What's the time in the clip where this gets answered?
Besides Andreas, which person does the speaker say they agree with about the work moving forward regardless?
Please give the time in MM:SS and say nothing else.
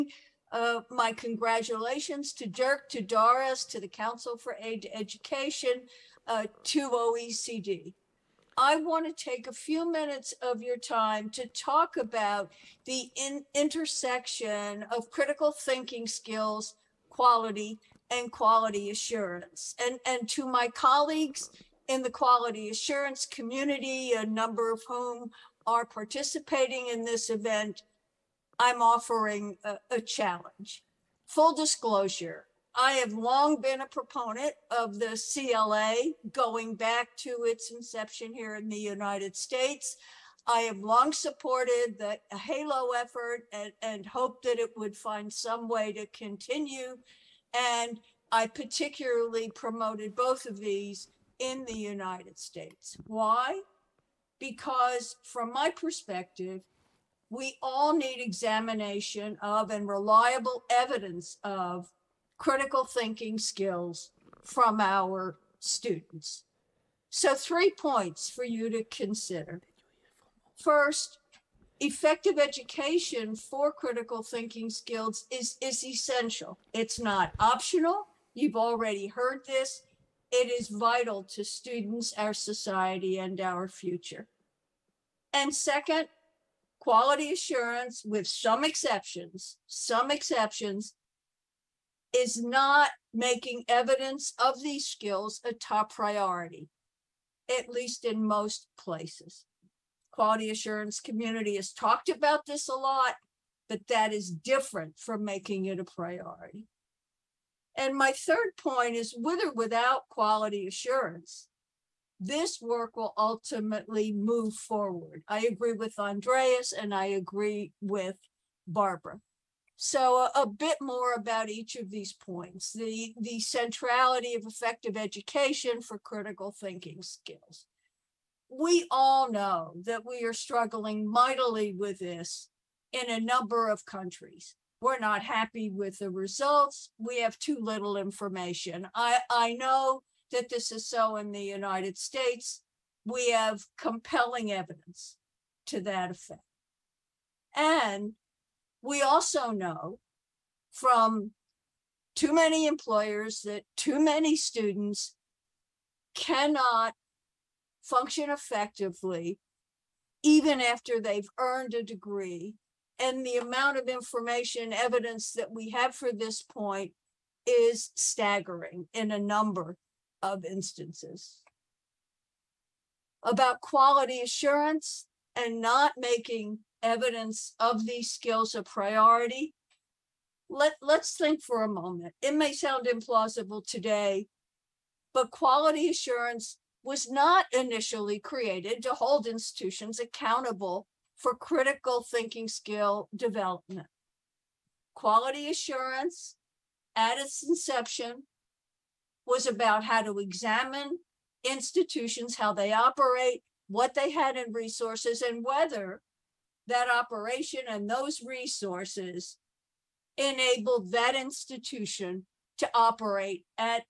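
01:58.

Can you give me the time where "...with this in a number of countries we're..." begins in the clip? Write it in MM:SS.
02:11.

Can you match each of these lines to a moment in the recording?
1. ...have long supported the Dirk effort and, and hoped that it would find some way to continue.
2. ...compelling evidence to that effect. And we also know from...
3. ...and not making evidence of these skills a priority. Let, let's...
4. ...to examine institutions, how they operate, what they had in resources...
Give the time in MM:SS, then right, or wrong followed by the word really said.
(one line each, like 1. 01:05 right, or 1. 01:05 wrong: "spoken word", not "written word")
1. 00:40 wrong: "AHELO", not "Dirk"
2. 02:23 right
3. 02:55 right
4. 03:20 right.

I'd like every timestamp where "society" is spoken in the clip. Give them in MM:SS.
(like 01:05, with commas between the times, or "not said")
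01:22.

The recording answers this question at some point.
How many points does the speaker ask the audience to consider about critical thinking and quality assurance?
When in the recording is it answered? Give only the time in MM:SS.
01:07.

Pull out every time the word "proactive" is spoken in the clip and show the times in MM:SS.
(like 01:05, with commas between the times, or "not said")
not said.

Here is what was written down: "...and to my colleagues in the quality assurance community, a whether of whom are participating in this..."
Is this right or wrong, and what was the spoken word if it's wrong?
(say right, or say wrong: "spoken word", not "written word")
wrong: "number", not "whether".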